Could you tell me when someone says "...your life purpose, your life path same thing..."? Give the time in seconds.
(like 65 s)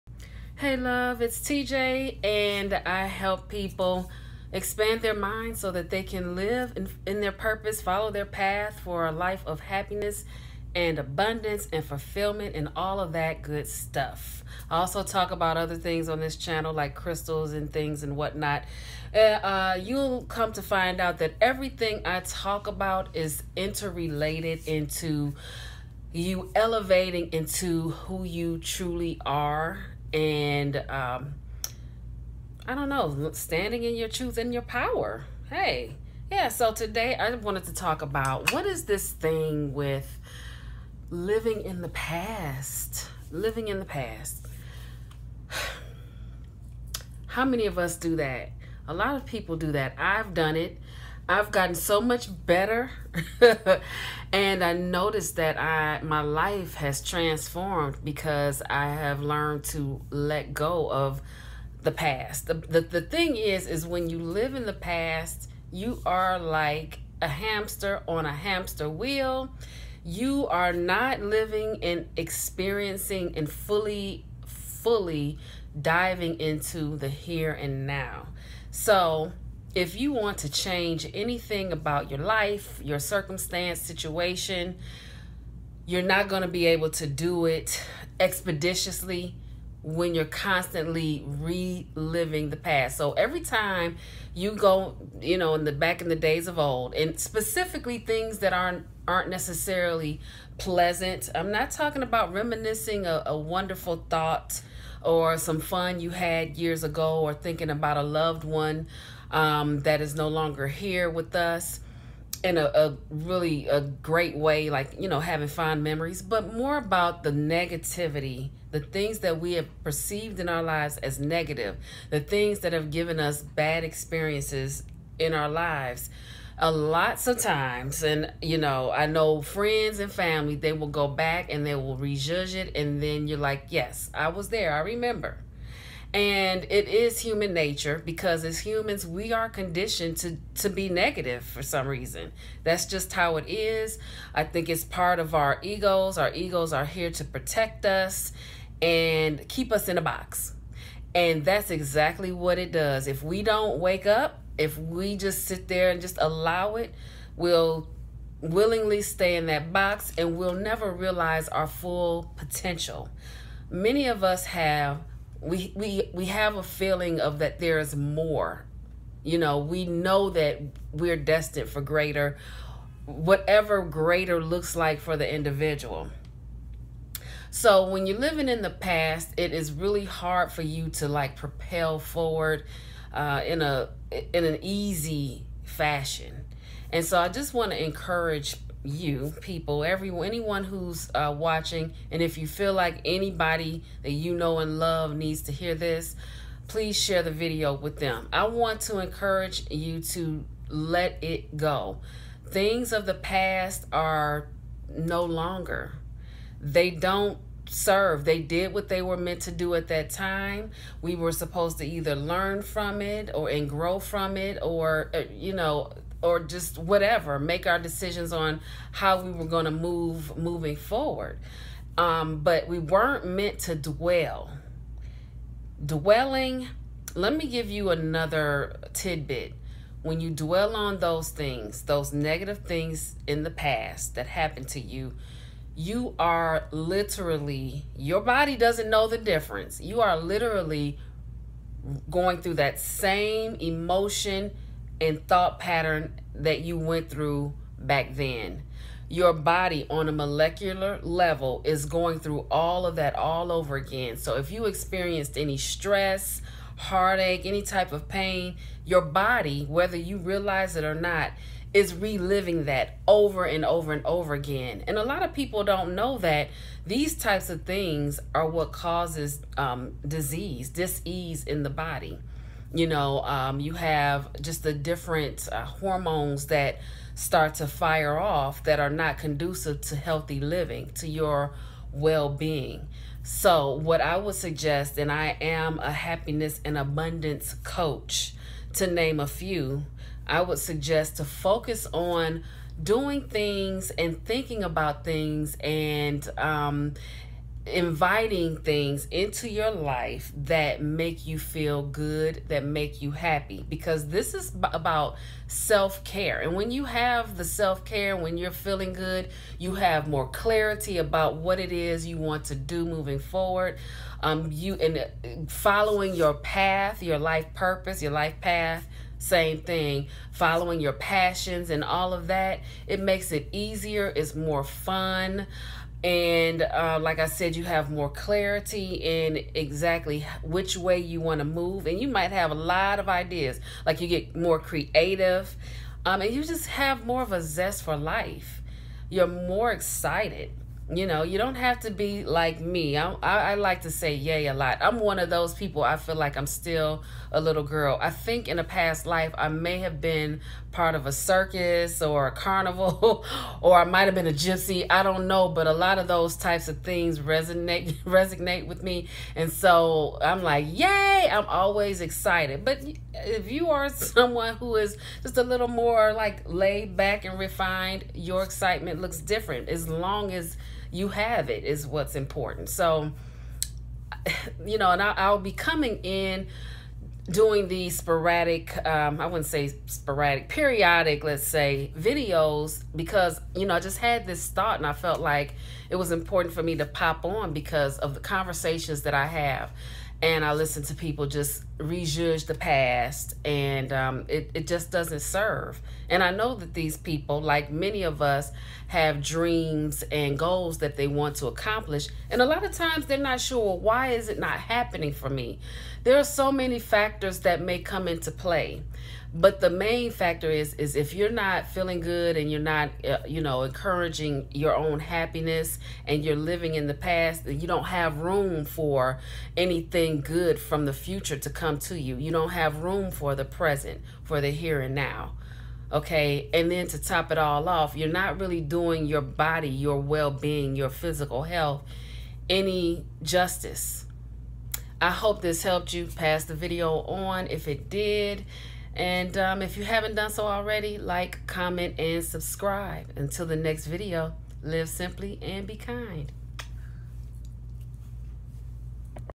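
317 s.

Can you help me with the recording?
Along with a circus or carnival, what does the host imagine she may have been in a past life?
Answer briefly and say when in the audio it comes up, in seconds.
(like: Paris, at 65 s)
A gypsy, at 354 s.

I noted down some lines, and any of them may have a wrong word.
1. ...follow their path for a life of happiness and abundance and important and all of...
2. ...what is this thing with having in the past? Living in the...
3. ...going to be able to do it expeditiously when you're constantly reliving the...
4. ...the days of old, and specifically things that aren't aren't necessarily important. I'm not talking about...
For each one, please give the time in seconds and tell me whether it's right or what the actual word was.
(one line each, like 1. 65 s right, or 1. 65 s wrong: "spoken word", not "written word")
1. 7 s wrong: "fulfillment", not "important"
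2. 38 s wrong: "living", not "having"
3. 86 s right
4. 96 s wrong: "pleasant", not "important".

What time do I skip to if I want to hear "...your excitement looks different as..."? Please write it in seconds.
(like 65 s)
368 s.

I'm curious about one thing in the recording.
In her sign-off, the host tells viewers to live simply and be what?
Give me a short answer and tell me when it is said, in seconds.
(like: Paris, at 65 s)
Kind, at 445 s.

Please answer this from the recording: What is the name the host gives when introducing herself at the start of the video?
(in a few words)
TJ.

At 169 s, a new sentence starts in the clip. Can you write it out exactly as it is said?
You know, we know that we're destined for greater whatever greater looks like for the individual.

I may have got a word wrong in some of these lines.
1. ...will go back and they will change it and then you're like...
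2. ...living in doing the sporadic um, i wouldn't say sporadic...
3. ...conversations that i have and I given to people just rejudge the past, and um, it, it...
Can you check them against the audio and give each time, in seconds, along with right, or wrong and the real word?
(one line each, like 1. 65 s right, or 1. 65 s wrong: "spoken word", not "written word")
1. 130 s wrong: "rejudge", not "change"
2. 375 s wrong: "coming", not "living"
3. 388 s wrong: "listen", not "given".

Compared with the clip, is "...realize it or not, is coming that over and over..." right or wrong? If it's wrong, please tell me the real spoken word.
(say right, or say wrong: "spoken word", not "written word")
wrong: "reliving", not "coming".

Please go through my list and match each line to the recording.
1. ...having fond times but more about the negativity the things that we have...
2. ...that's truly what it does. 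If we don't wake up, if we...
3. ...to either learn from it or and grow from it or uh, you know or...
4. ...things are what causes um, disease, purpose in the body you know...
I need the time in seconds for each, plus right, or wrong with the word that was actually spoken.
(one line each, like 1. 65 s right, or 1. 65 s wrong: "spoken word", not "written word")
1. 115 s wrong: "memories", not "times"
2. 151 s wrong: "exactly", not "truly"
3. 211 s right
4. 267 s wrong: "disease", not "purpose".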